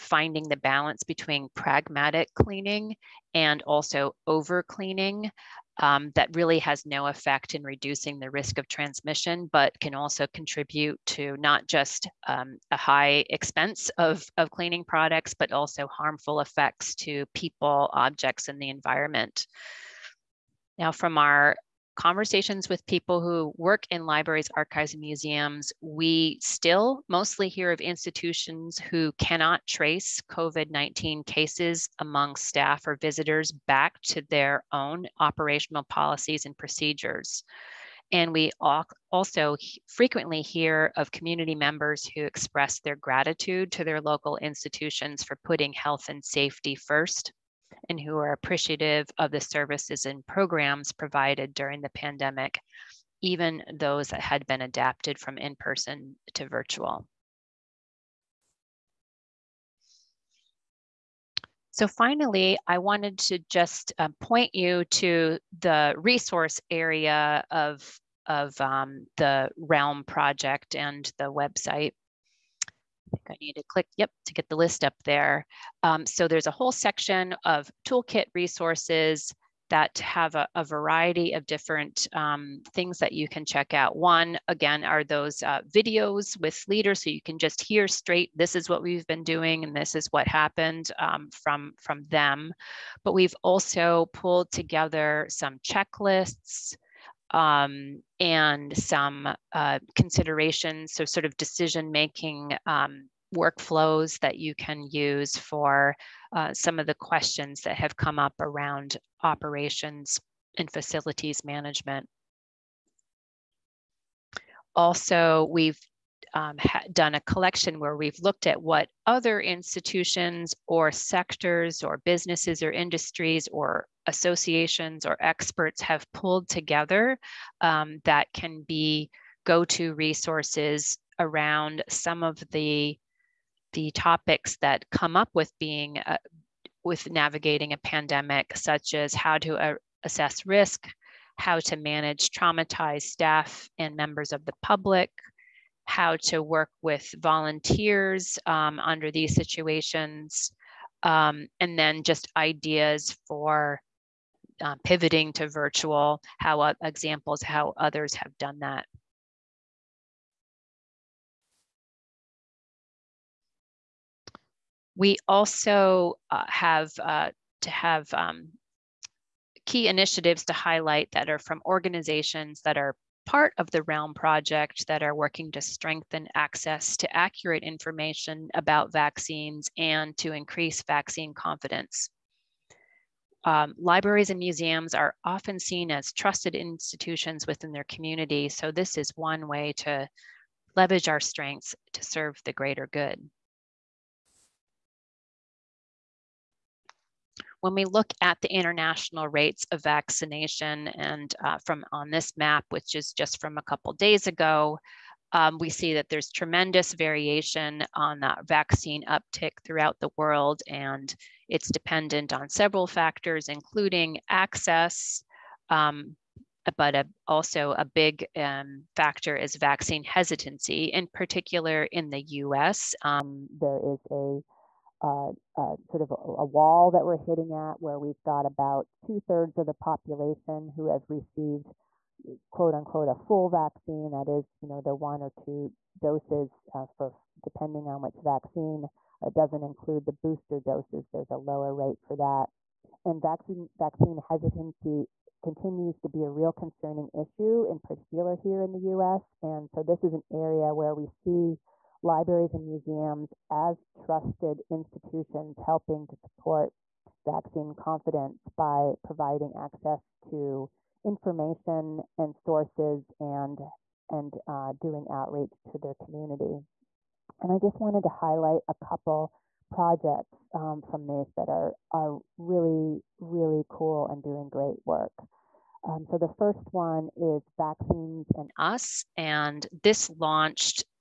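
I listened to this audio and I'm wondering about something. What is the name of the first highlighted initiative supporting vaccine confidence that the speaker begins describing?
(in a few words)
Vaccines and Us.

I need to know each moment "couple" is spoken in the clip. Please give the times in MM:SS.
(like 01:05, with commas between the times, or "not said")
03:23, 04:28.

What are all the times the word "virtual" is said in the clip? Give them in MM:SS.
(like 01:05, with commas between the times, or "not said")
00:56, 02:35.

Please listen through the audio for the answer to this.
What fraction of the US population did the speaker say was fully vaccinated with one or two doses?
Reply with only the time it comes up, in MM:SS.
03:48.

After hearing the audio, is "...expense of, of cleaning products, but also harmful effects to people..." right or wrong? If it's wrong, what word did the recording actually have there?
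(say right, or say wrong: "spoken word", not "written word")
right.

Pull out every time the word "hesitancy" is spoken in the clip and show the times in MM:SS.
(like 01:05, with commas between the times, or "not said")
03:40, 04:04.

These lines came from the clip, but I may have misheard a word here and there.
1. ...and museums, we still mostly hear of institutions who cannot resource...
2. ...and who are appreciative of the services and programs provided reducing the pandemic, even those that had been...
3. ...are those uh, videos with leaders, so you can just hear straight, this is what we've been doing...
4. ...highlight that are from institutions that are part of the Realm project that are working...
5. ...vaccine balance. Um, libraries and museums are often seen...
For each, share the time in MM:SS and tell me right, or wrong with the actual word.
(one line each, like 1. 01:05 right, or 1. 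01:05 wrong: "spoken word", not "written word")
1. 00:24 wrong: "trace", not "resource"
2. 00:47 wrong: "during", not "reducing"
3. 01:24 right
4. 02:50 wrong: "organizations", not "institutions"
5. 03:00 wrong: "confidence", not "balance".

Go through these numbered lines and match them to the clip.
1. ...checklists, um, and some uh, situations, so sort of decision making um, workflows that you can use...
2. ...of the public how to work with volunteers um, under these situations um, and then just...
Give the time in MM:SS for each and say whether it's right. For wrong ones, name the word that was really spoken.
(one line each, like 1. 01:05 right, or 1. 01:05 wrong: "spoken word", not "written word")
1. 01:35 wrong: "considerations", not "situations"
2. 02:24 right.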